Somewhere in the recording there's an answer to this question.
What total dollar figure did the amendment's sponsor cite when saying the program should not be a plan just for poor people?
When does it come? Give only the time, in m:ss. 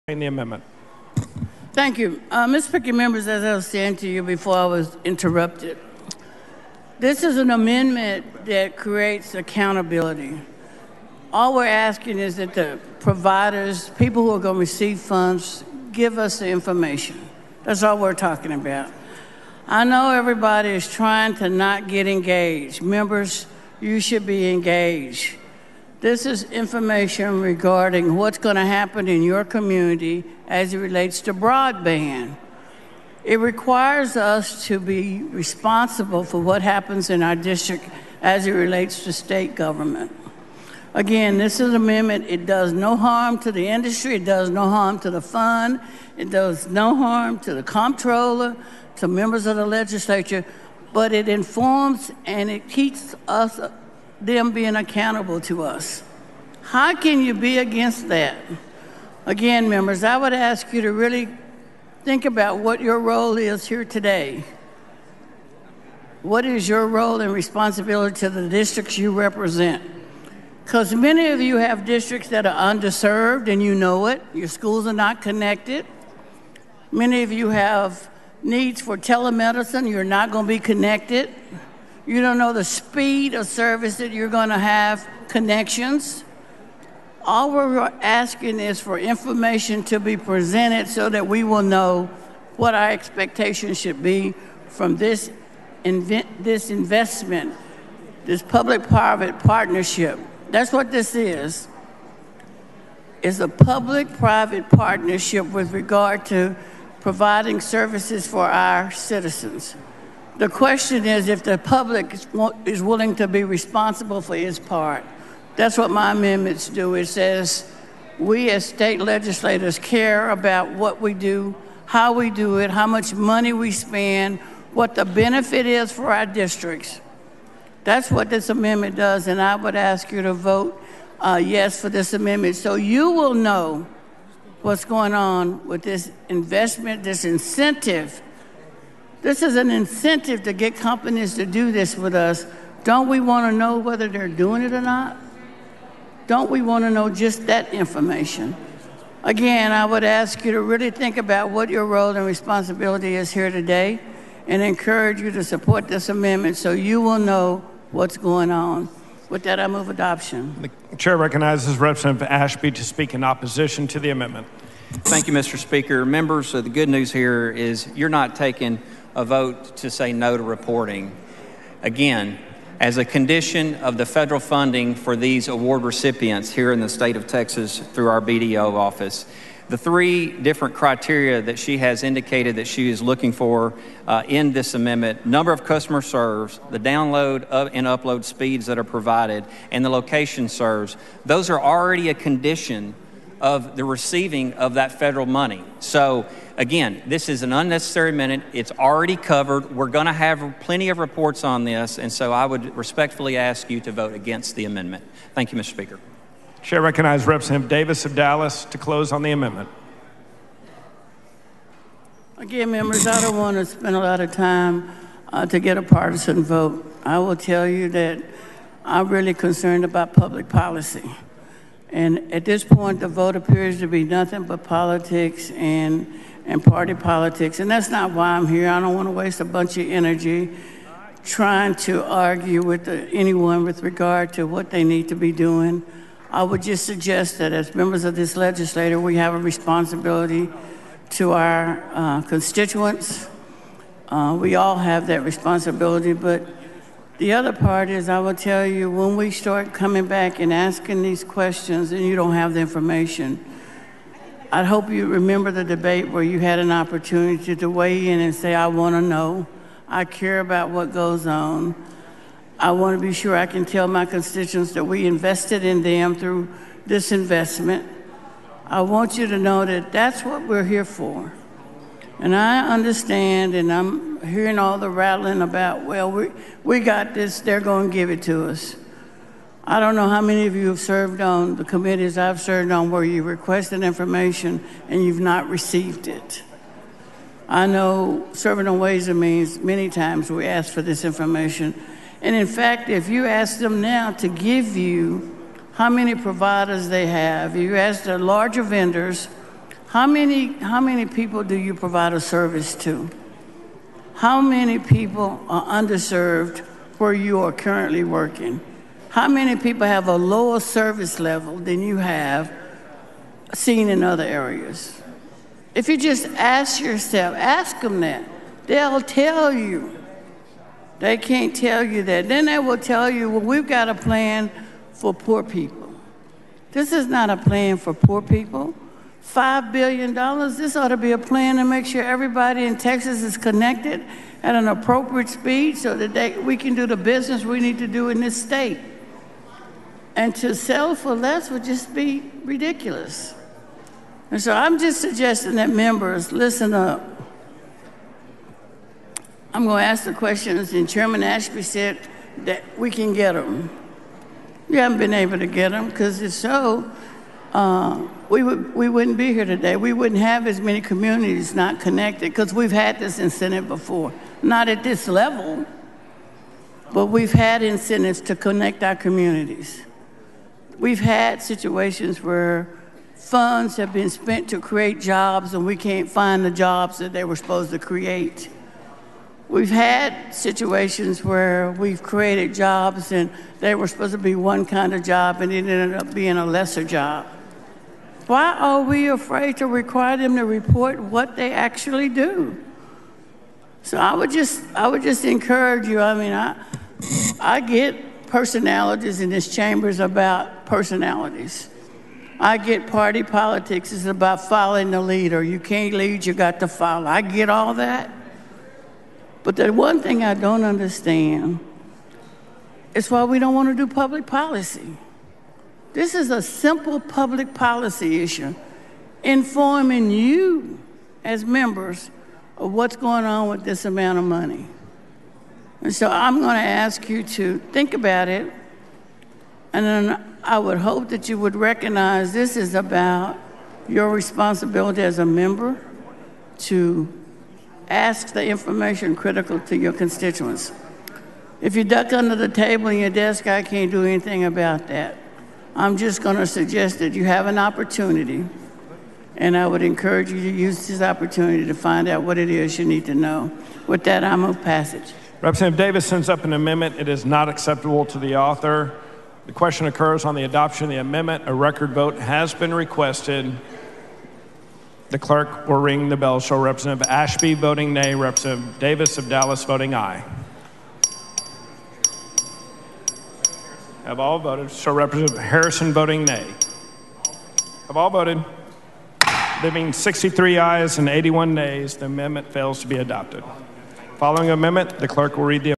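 5:29.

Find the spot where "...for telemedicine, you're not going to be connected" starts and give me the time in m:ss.
1:18.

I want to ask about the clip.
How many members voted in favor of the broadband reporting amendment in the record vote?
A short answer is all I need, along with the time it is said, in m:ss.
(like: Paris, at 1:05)
63, at 7:59.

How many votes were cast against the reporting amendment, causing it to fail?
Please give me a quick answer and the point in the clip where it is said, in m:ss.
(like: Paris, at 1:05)
81, at 8:01.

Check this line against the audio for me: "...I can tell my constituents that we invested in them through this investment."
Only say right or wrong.
right.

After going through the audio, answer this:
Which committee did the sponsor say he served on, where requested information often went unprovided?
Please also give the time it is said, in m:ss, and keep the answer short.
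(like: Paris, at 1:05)
Ways and Means, at 4:48.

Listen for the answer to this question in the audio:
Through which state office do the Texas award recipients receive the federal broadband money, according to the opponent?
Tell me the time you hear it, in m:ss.
2:58.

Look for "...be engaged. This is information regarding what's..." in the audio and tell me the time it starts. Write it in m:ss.
0:24.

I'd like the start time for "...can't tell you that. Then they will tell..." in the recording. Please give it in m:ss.
5:21.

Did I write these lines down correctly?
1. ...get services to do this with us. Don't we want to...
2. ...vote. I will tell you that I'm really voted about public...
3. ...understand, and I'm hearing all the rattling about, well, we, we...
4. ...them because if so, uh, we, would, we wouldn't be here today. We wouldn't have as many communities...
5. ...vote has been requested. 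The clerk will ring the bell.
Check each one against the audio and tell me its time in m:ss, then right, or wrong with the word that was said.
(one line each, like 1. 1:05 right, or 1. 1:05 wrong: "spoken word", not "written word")
1. 2:20 wrong: "companies", not "services"
2. 3:36 wrong: "concerned", not "voted"
3. 4:32 right
4. 5:55 right
5. 7:41 right.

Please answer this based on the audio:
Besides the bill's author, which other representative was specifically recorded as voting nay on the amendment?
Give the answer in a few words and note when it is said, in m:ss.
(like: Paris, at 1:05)
Representative Harrison, at 7:54.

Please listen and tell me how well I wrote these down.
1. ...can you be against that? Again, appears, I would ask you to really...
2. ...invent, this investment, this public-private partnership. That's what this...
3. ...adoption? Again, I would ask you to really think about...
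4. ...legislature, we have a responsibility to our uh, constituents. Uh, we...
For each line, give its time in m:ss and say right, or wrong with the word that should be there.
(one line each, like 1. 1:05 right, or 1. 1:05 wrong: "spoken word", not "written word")
1. 0:56 wrong: "members", not "appears"
2. 1:35 right
3. 2:27 wrong: "information", not "adoption"
4. 3:58 right.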